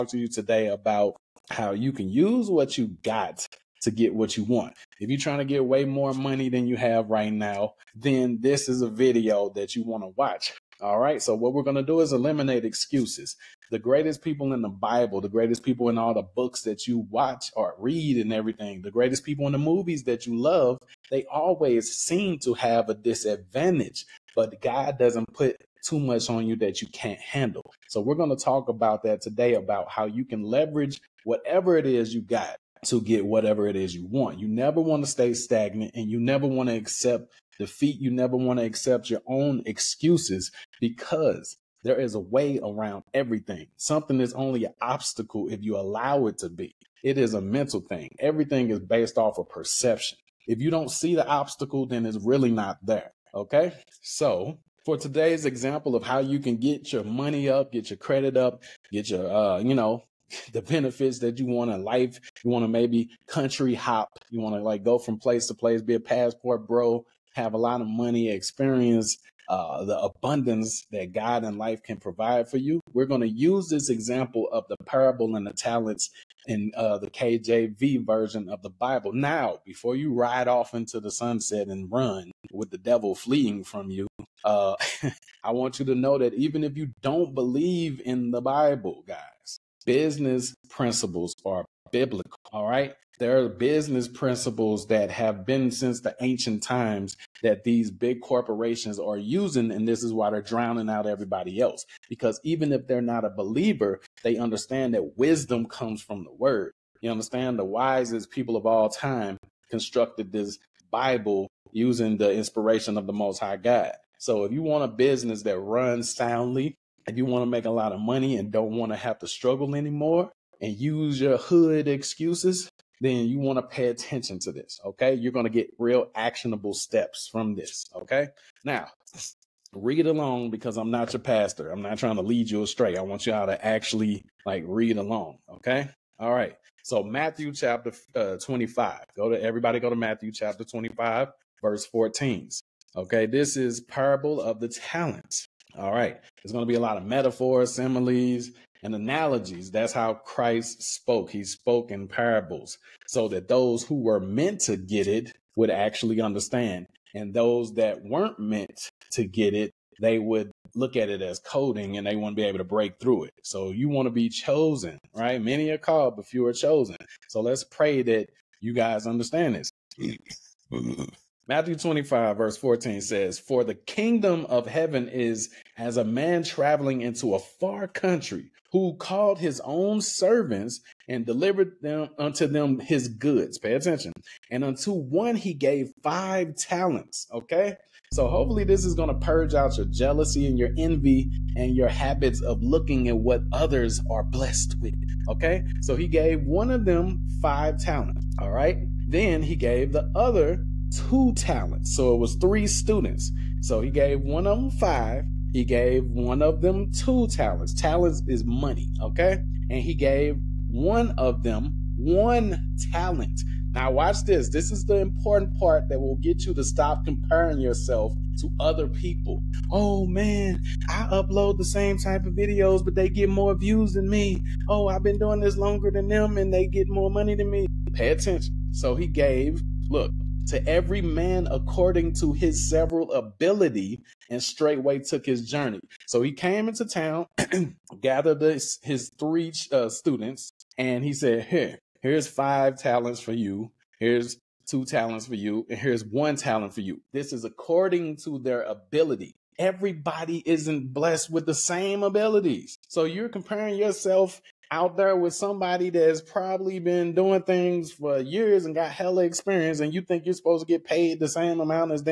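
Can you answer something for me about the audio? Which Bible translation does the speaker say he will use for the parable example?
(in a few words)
KJV.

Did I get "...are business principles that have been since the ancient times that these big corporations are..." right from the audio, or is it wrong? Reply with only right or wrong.
right.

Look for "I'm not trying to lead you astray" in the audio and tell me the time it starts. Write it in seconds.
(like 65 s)
131 s.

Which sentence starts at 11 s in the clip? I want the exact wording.
So what we're going to do is eliminate excuses.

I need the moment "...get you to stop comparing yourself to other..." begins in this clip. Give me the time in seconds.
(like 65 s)
216 s.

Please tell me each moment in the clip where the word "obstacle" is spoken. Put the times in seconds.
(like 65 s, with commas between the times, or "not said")
44 s, 51 s.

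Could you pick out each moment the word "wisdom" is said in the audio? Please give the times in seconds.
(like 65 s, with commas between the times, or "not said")
105 s.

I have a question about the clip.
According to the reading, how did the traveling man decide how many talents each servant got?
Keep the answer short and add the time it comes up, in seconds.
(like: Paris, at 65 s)
several ability, at 232 s.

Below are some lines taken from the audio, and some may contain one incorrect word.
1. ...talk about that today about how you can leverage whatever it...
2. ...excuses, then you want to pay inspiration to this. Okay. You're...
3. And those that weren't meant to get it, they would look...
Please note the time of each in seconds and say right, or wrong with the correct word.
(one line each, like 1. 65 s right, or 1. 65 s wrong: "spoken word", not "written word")
1. 28 s right
2. 121 s wrong: "attention", not "inspiration"
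3. 157 s right.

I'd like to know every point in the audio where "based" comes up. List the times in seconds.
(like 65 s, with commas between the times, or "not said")
48 s.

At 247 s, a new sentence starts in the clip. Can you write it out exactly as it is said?
This is according to their ability.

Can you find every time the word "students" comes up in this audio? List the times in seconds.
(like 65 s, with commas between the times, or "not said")
202 s, 239 s.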